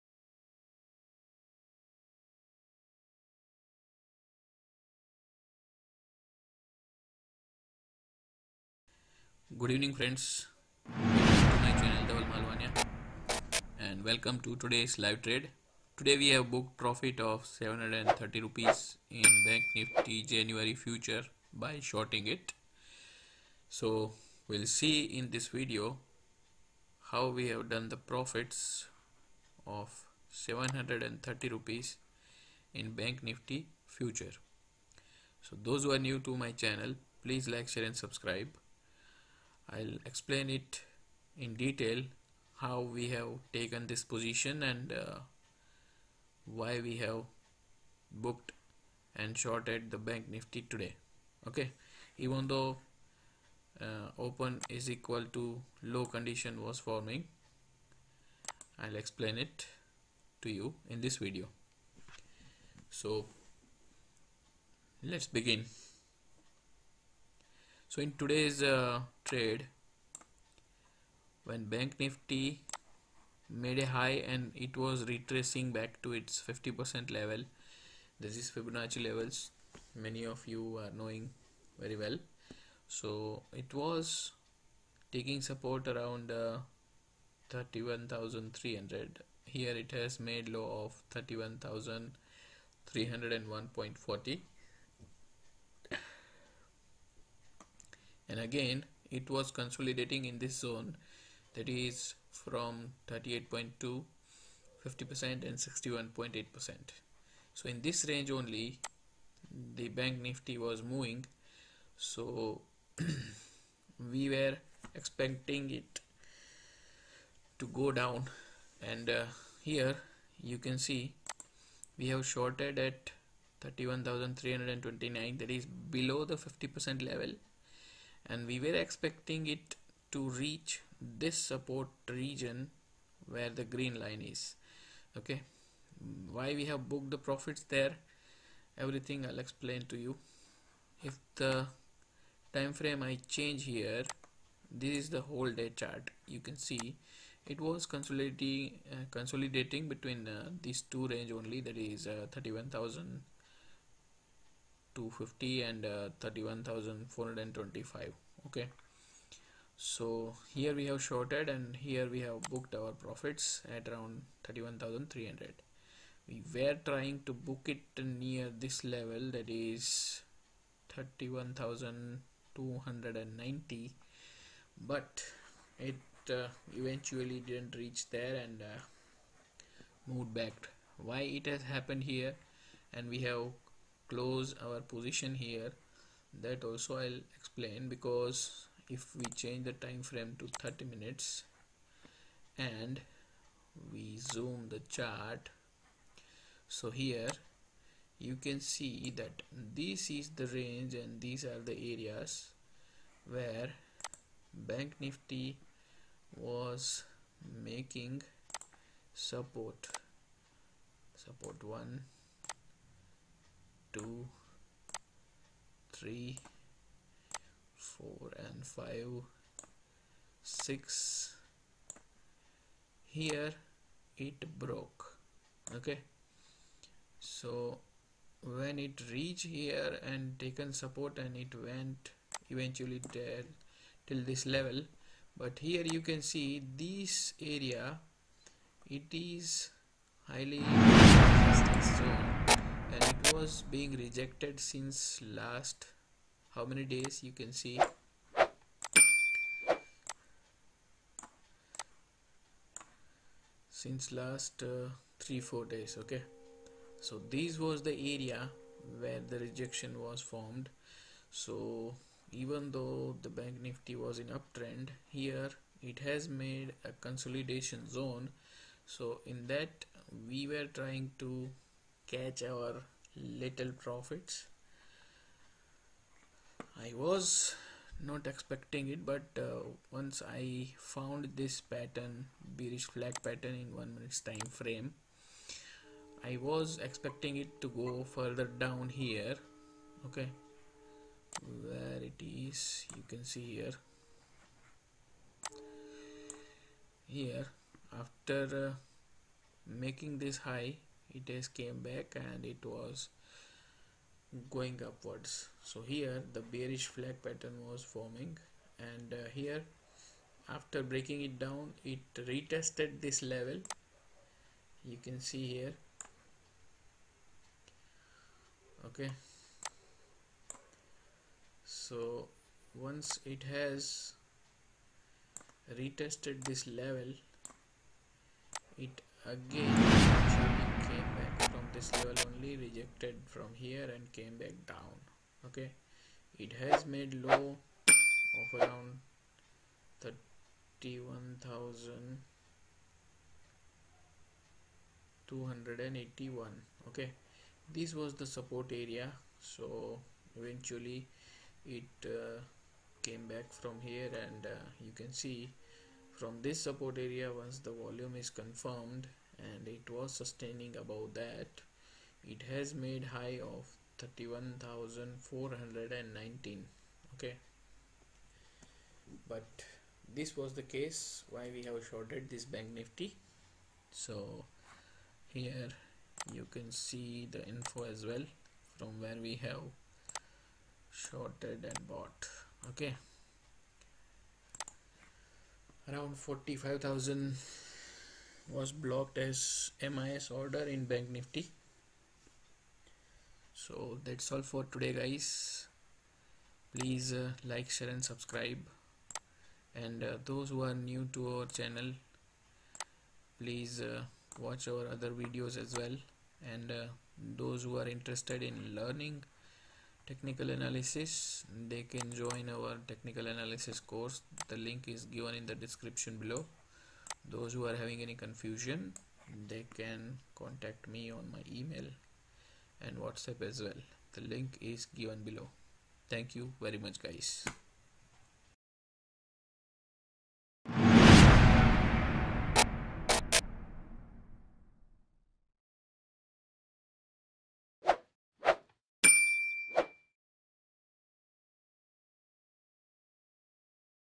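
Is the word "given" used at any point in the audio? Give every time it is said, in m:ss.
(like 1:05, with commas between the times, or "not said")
6:55, 7:04.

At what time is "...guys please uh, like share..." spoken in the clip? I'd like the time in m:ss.
6:34.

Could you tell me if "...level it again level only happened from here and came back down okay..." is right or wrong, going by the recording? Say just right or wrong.
wrong.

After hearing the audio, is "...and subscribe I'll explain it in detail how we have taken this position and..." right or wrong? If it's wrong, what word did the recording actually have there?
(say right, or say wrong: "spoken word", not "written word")
right.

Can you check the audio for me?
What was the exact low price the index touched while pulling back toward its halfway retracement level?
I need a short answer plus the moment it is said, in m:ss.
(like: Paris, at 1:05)
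31,301.40, at 1:31.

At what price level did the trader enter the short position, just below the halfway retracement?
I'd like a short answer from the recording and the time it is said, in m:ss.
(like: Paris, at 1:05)
31,329, at 2:03.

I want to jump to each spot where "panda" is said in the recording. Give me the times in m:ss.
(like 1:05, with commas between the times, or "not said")
not said.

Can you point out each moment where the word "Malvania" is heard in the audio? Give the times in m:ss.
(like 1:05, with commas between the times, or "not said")
0:12.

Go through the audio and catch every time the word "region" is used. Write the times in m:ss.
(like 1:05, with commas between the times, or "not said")
2:12.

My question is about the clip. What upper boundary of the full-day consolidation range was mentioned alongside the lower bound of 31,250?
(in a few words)
31,425.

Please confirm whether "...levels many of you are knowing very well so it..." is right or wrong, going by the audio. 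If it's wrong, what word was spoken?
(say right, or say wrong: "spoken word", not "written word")
right.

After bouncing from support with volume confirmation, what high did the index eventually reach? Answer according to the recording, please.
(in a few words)
31,419.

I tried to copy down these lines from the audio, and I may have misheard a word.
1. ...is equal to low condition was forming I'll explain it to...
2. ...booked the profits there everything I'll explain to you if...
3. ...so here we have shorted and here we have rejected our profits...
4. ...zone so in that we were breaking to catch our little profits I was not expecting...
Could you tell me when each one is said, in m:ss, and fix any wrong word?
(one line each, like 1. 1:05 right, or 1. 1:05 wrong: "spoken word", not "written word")
1. 0:54 right
2. 2:16 right
3. 2:39 wrong: "booked", not "rejected"
4. 4:27 wrong: "trying", not "breaking".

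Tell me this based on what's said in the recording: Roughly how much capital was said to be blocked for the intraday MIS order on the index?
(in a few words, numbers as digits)
45,000.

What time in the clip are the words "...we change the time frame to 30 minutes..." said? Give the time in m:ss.
3:09.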